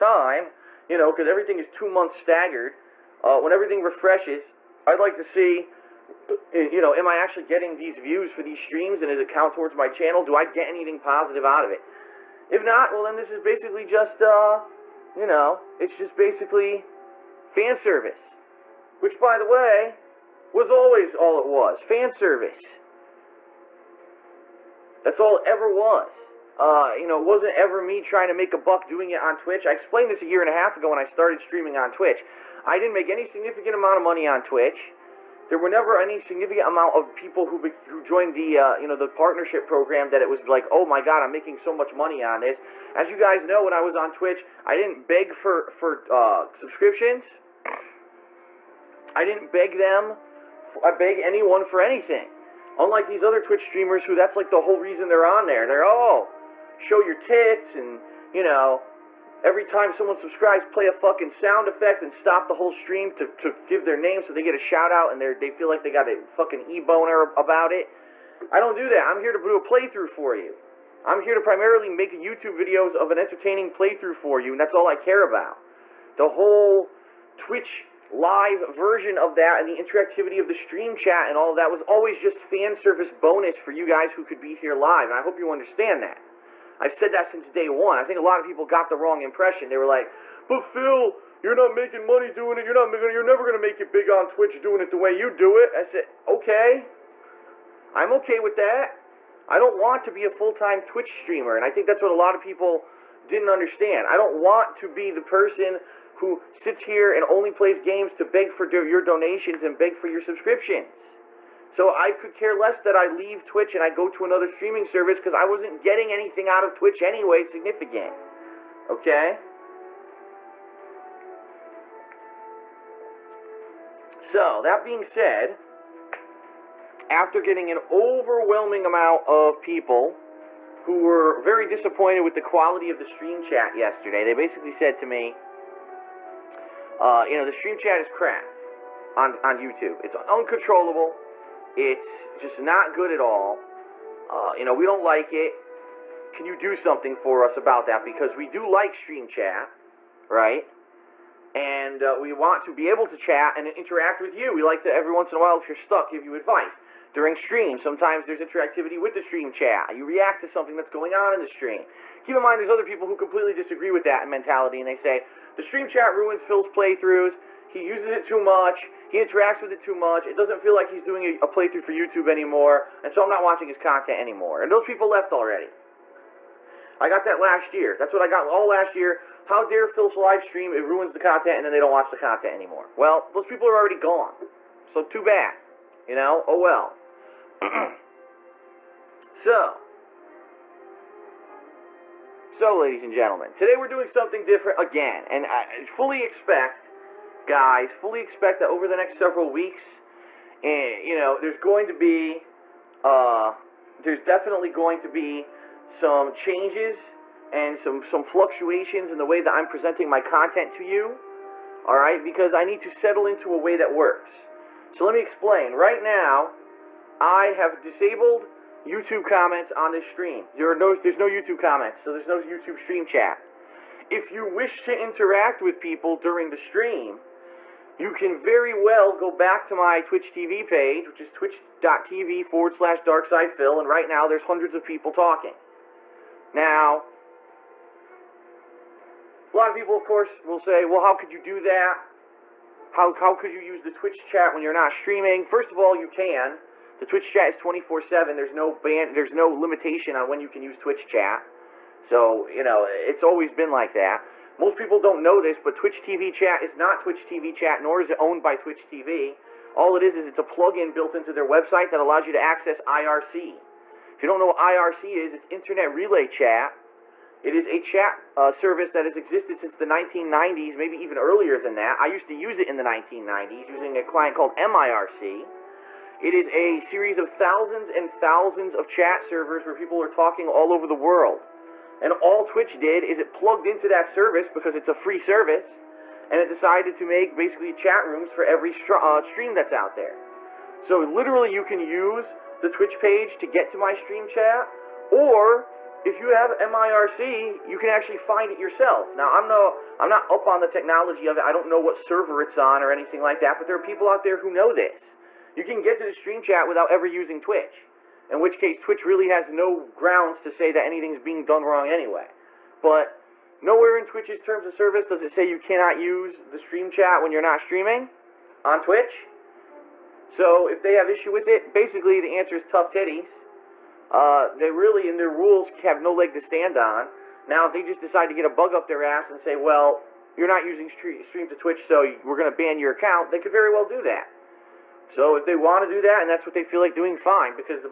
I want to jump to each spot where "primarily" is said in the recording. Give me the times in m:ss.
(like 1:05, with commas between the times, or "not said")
1:11.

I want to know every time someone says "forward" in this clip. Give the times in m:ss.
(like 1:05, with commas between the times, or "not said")
3:52.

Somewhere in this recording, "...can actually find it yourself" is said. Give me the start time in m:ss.
4:57.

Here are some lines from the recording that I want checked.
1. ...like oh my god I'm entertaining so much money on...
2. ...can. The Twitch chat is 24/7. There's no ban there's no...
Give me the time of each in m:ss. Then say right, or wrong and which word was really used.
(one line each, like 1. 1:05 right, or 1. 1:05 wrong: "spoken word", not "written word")
1. 0:40 wrong: "making", not "entertaining"
2. 4:06 right.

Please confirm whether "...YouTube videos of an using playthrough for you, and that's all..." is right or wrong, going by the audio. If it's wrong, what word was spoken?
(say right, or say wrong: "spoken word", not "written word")
wrong: "entertaining", not "using".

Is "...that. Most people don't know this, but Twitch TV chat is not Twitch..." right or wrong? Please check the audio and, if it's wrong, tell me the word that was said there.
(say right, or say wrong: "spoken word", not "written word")
right.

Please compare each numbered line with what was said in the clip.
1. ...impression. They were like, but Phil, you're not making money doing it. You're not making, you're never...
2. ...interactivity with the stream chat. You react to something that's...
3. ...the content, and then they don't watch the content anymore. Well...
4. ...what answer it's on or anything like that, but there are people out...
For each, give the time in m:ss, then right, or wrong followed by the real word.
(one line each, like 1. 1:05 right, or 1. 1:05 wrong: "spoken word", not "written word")
1. 1:29 right
2. 2:38 right
3. 3:01 right
4. 5:01 wrong: "server", not "answer".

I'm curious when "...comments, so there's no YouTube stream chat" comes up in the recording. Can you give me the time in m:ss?
3:41.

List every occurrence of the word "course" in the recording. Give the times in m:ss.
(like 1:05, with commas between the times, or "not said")
4:00.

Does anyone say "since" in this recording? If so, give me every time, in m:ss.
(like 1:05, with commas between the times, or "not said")
1:27, 4:29.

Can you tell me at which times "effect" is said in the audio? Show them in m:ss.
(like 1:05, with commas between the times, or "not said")
1:01.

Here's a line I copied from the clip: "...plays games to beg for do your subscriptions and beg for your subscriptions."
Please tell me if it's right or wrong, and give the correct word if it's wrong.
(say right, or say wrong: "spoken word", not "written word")
wrong: "donations", not "subscriptions".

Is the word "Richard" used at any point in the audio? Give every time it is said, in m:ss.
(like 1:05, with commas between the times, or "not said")
not said.